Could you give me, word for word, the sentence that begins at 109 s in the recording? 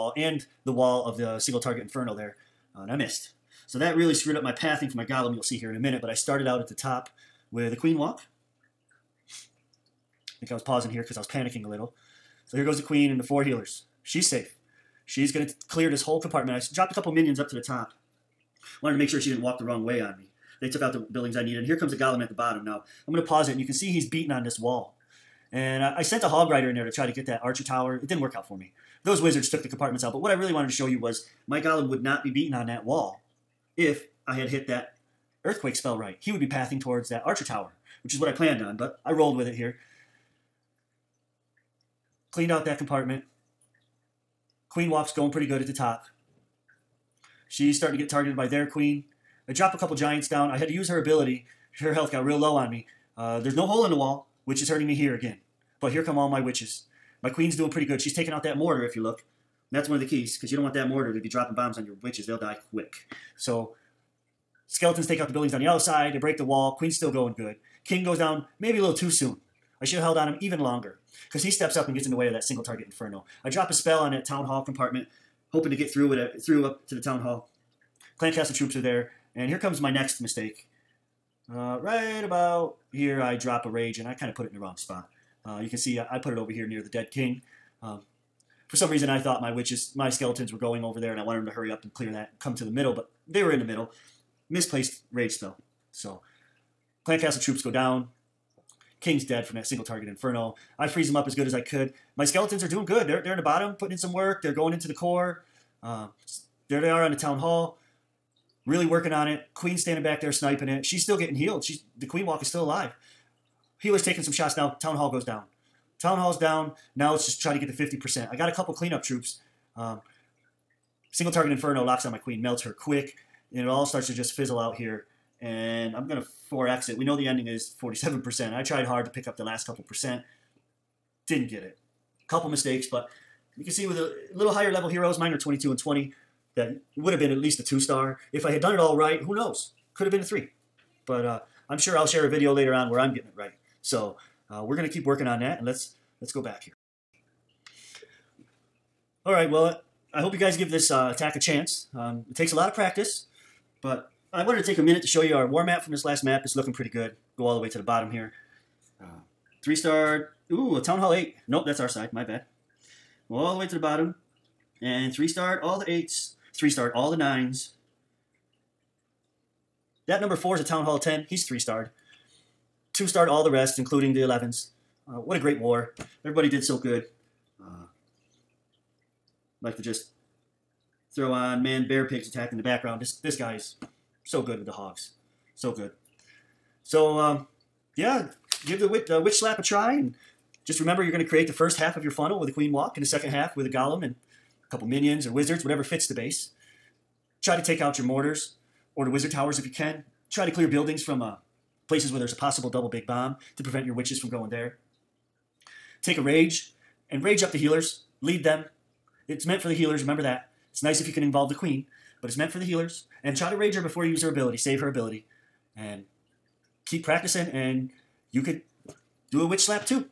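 Queen standing back there sniping it.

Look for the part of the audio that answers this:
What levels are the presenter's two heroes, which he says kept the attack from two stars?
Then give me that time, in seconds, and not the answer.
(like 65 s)
135 s.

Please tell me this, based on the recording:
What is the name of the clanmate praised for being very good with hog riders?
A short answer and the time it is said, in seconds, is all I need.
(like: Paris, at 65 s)
man bear pigs, at 181 s.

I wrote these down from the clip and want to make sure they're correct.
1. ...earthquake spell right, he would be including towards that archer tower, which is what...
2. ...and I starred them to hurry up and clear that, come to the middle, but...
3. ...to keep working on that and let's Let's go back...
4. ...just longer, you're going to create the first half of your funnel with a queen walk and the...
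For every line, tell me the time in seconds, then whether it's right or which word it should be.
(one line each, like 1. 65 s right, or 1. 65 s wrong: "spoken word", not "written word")
1. 35 s wrong: "pathing", not "including"
2. 91 s wrong: "wanted", not "starred"
3. 144 s right
4. 190 s wrong: "remember", not "longer".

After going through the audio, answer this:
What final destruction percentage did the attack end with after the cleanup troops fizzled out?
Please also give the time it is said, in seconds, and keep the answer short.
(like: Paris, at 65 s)
47%, at 127 s.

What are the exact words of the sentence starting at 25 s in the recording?
And I, I sent a hog rider in there to try to get that archer tower.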